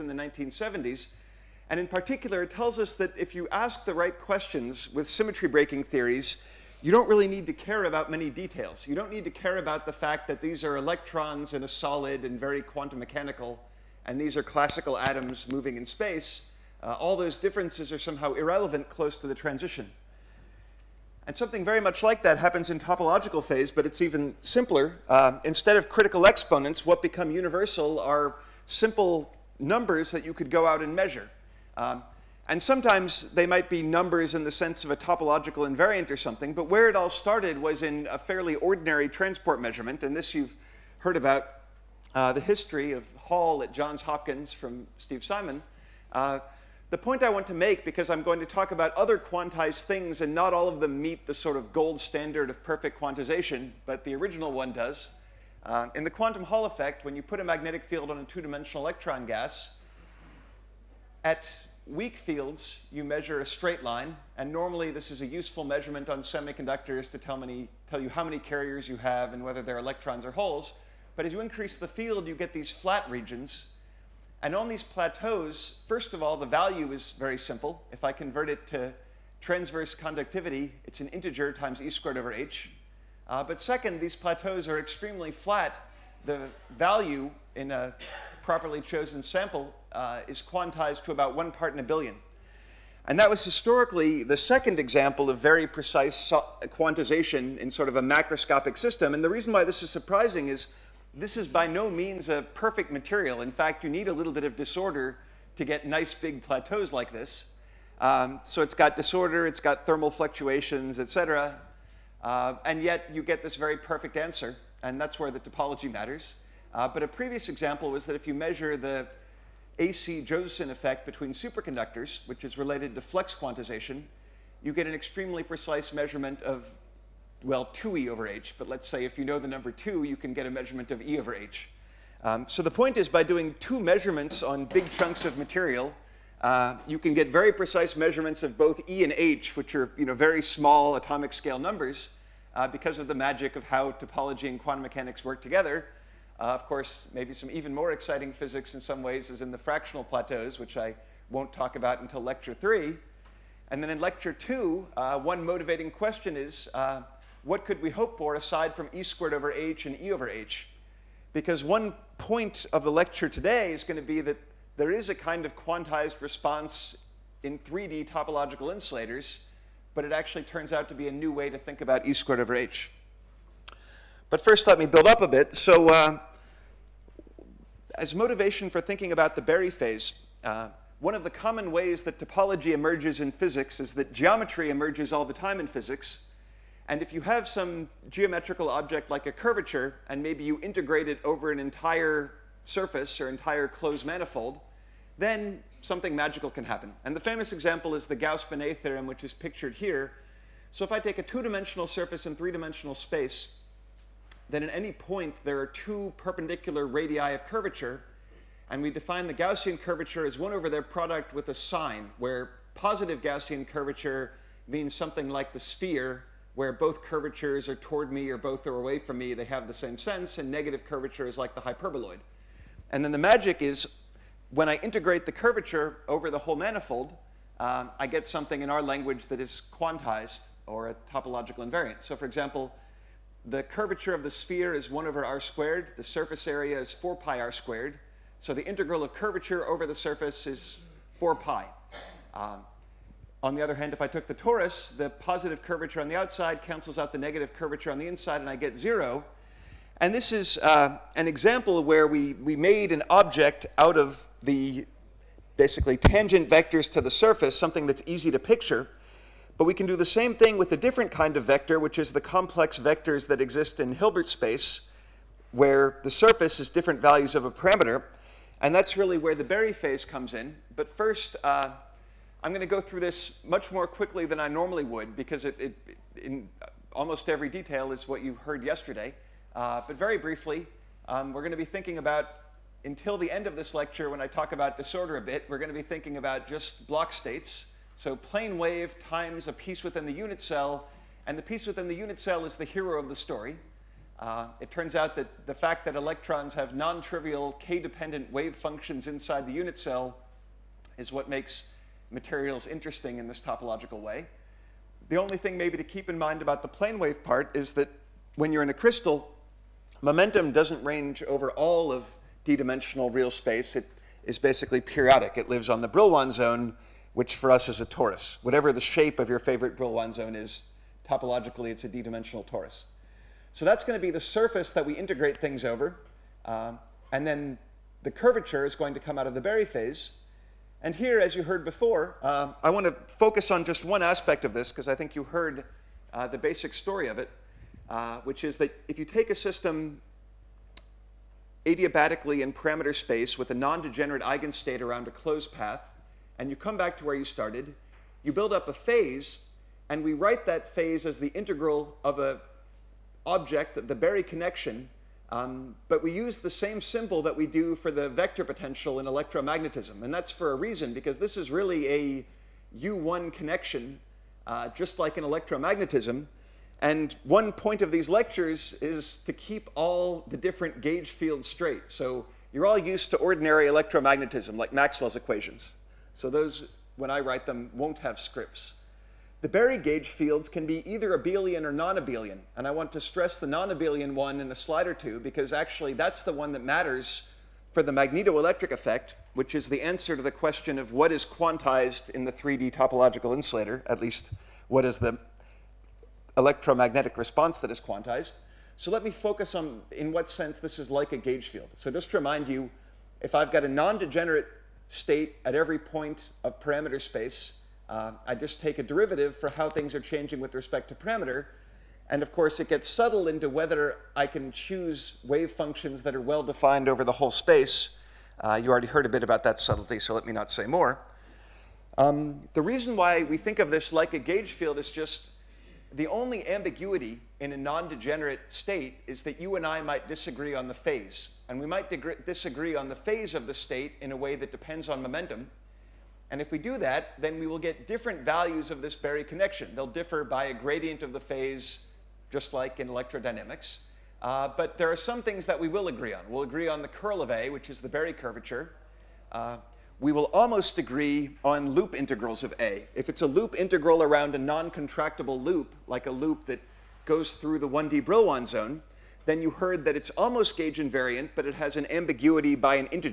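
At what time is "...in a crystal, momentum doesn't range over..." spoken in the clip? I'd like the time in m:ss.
5:08.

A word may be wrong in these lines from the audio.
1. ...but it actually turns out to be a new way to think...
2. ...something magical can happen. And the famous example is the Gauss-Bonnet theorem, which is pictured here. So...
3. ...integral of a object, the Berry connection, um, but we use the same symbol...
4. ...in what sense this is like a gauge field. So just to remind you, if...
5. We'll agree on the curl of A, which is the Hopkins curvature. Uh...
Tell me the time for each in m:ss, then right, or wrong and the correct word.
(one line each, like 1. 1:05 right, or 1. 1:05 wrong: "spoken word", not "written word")
1. 2:49 right
2. 3:15 right
3. 5:51 right
4. 6:39 right
5. 7:26 wrong: "Berry", not "Hopkins".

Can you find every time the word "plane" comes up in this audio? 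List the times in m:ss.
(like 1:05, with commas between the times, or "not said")
4:48, 5:06.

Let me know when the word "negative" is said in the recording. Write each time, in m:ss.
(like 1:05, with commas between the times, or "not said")
3:40, 4:07.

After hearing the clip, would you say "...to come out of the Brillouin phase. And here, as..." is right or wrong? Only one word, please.
wrong.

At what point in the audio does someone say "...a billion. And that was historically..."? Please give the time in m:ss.
1:31.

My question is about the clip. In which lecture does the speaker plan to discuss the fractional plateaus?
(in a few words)
lecture 3.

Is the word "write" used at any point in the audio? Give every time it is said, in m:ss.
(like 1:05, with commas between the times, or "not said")
5:50, 6:17.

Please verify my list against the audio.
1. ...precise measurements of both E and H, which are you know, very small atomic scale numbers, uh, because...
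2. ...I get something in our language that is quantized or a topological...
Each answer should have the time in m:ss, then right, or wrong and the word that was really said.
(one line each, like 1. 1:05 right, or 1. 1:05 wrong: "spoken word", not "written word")
1. 2:17 right
2. 3:47 right.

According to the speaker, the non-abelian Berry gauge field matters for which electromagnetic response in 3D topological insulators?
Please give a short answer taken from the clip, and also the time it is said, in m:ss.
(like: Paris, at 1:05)
magnetoelectric effect, at 6:27.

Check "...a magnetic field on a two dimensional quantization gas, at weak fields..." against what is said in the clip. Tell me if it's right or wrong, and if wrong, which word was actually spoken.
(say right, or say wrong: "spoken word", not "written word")
wrong: "electron", not "quantization".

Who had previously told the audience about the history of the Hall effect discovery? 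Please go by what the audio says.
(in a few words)
Steve Simon.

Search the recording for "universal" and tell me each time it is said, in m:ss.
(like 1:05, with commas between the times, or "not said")
0:27.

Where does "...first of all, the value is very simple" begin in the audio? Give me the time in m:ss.
1:15.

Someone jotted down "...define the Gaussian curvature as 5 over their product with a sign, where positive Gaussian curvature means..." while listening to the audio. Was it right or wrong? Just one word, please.
wrong.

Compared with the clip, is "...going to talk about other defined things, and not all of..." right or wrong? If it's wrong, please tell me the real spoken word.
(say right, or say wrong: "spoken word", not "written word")
wrong: "quantized", not "defined".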